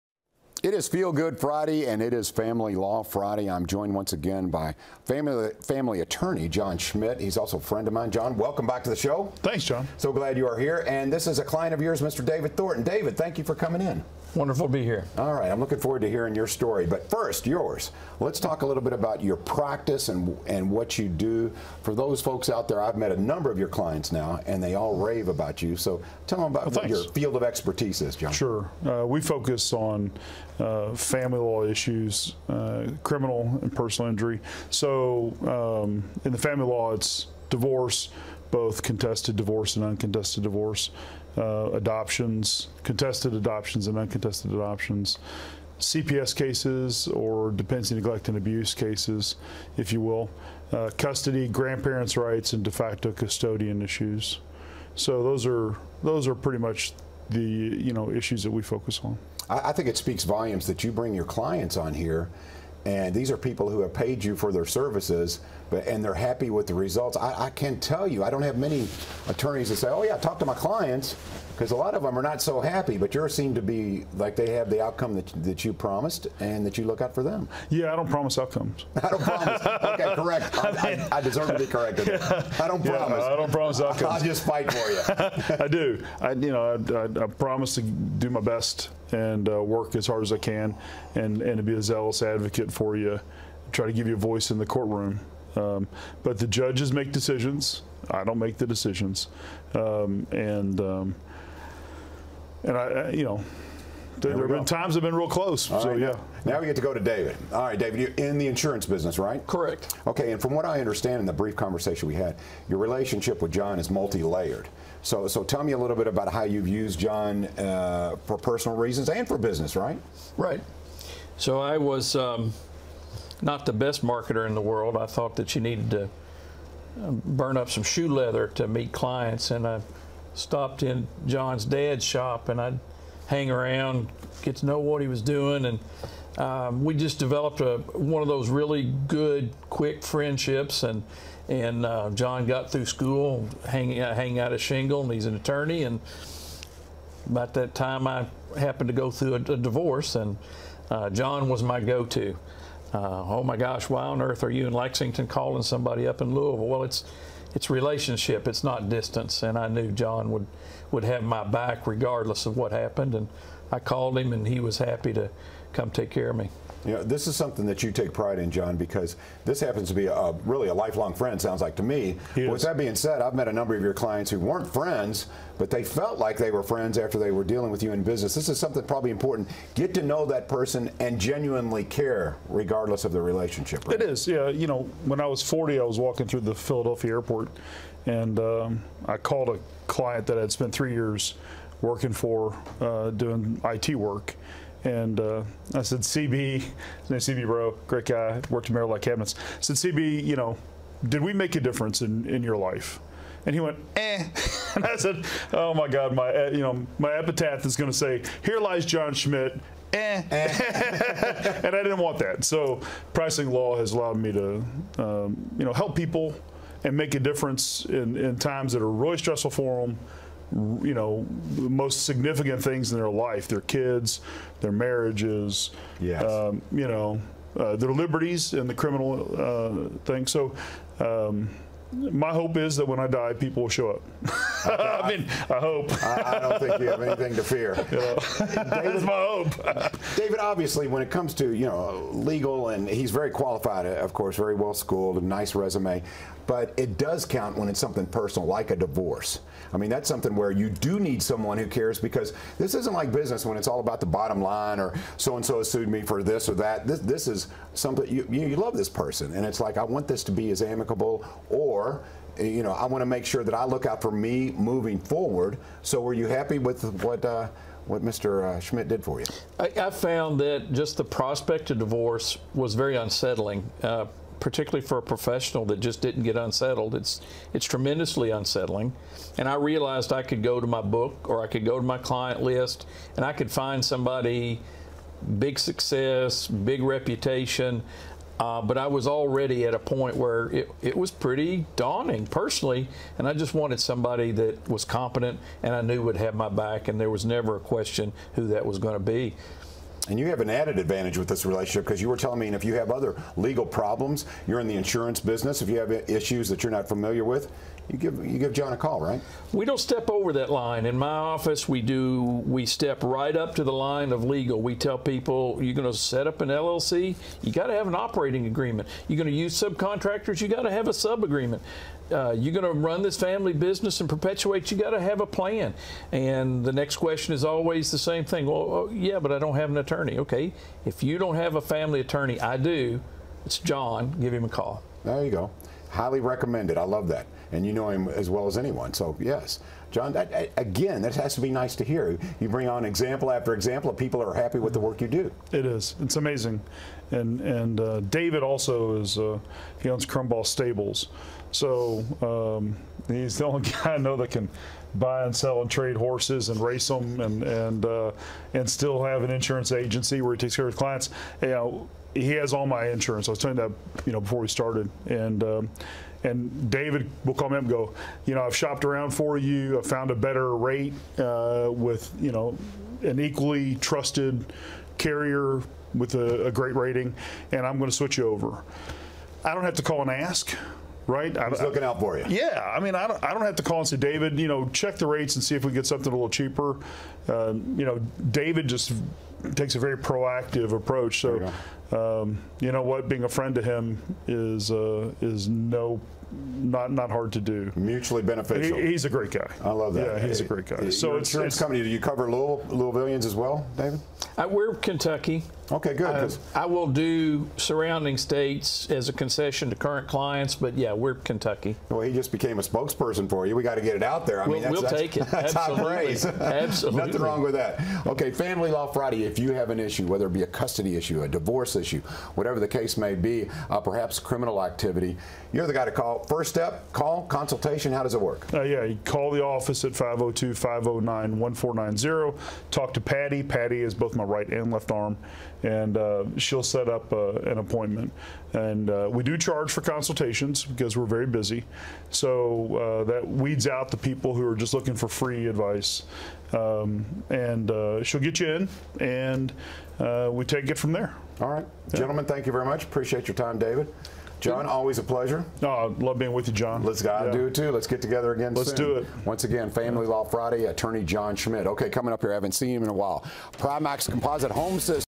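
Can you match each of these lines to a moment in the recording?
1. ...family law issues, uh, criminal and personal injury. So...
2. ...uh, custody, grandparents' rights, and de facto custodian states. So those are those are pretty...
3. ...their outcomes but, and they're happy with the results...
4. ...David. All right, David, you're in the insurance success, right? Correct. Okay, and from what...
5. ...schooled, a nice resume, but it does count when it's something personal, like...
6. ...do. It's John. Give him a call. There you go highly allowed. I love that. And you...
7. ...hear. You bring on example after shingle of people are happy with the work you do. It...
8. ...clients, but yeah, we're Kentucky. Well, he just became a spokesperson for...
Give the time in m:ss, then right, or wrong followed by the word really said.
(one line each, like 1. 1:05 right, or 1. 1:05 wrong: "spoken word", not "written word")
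1. 0:30 right
2. 0:50 wrong: "issues", not "states"
3. 1:04 wrong: "services", not "outcomes"
4. 1:46 wrong: "business", not "success"
5. 4:04 right
6. 5:32 wrong: "recommended", not "allowed"
7. 5:41 wrong: "example", not "shingle"
8. 6:50 right.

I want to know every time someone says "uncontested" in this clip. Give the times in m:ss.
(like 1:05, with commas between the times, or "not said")
0:39, 0:43.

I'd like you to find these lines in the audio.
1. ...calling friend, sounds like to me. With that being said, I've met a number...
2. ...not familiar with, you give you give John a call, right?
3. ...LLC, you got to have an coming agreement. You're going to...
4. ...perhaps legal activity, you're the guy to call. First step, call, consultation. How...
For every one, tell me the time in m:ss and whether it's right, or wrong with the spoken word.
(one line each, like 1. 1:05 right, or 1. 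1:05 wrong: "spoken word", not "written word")
1. 2:50 wrong: "lifelong", not "calling"
2. 5:06 right
3. 5:16 wrong: "operating", not "coming"
4. 7:03 wrong: "criminal", not "legal".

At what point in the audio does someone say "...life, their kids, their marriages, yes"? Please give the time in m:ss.
3:43.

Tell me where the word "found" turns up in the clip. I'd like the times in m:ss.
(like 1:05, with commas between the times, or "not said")
4:29, 6:09.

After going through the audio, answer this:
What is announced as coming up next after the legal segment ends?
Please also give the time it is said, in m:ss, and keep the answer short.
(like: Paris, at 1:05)
Primax Composite Home System, at 7:43.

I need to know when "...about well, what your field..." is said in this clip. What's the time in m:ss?
0:26.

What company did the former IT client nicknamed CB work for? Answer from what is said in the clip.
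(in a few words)
Merrill Cabinets.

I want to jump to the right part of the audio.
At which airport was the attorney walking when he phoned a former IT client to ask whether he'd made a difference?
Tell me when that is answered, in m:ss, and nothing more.
3:06.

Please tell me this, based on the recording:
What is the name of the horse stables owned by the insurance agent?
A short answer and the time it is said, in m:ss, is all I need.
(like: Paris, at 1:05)
Crumball Stables, at 5:50.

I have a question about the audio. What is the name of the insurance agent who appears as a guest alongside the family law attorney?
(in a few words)
David Thornton.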